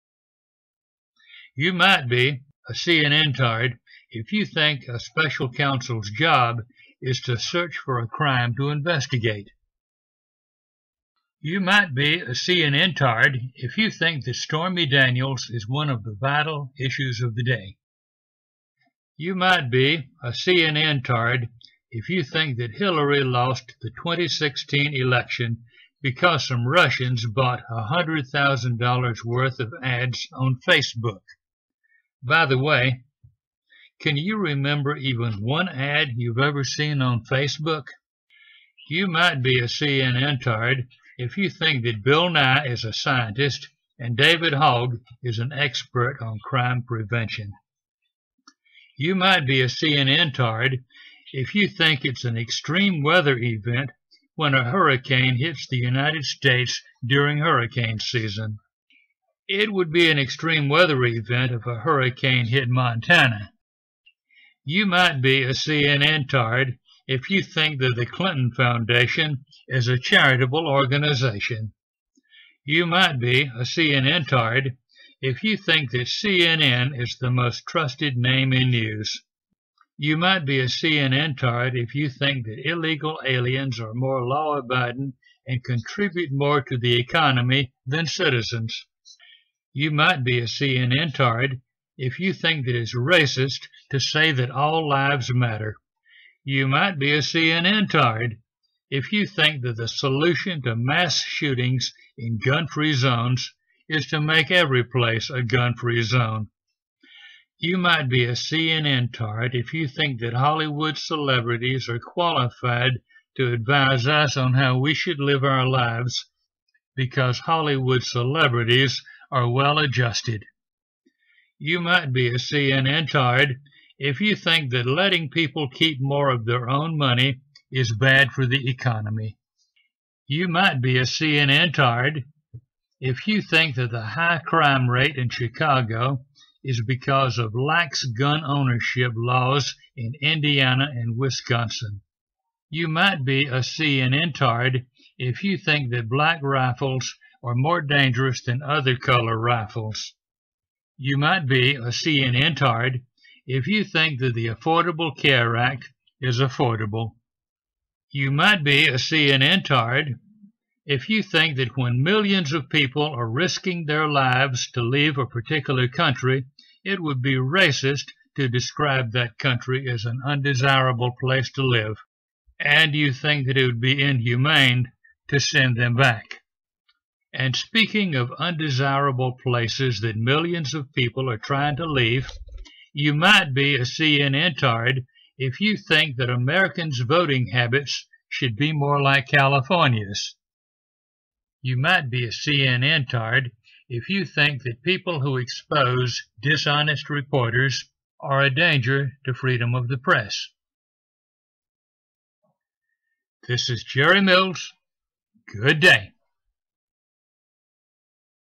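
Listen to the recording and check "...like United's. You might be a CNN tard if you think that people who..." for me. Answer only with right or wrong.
wrong.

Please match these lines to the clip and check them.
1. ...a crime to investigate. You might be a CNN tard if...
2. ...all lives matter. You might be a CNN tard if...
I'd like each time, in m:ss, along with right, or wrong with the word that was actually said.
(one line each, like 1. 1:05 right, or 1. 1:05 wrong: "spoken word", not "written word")
1. 0:07 right
2. 1:34 right.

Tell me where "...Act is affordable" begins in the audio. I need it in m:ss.
2:35.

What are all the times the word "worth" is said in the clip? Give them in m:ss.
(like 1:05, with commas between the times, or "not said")
0:29.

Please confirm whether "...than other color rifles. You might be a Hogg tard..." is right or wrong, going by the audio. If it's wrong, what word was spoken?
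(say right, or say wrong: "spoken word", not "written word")
wrong: "CNN", not "Hogg".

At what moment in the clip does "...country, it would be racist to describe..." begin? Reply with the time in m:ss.
2:45.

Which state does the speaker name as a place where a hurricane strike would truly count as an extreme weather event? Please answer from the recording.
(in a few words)
Montana.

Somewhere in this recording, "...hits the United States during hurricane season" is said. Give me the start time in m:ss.
0:55.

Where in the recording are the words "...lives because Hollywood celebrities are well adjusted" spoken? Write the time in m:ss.
1:55.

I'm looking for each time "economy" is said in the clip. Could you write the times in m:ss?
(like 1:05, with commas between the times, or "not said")
1:26, 2:08.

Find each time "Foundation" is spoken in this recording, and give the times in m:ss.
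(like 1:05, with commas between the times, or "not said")
1:08.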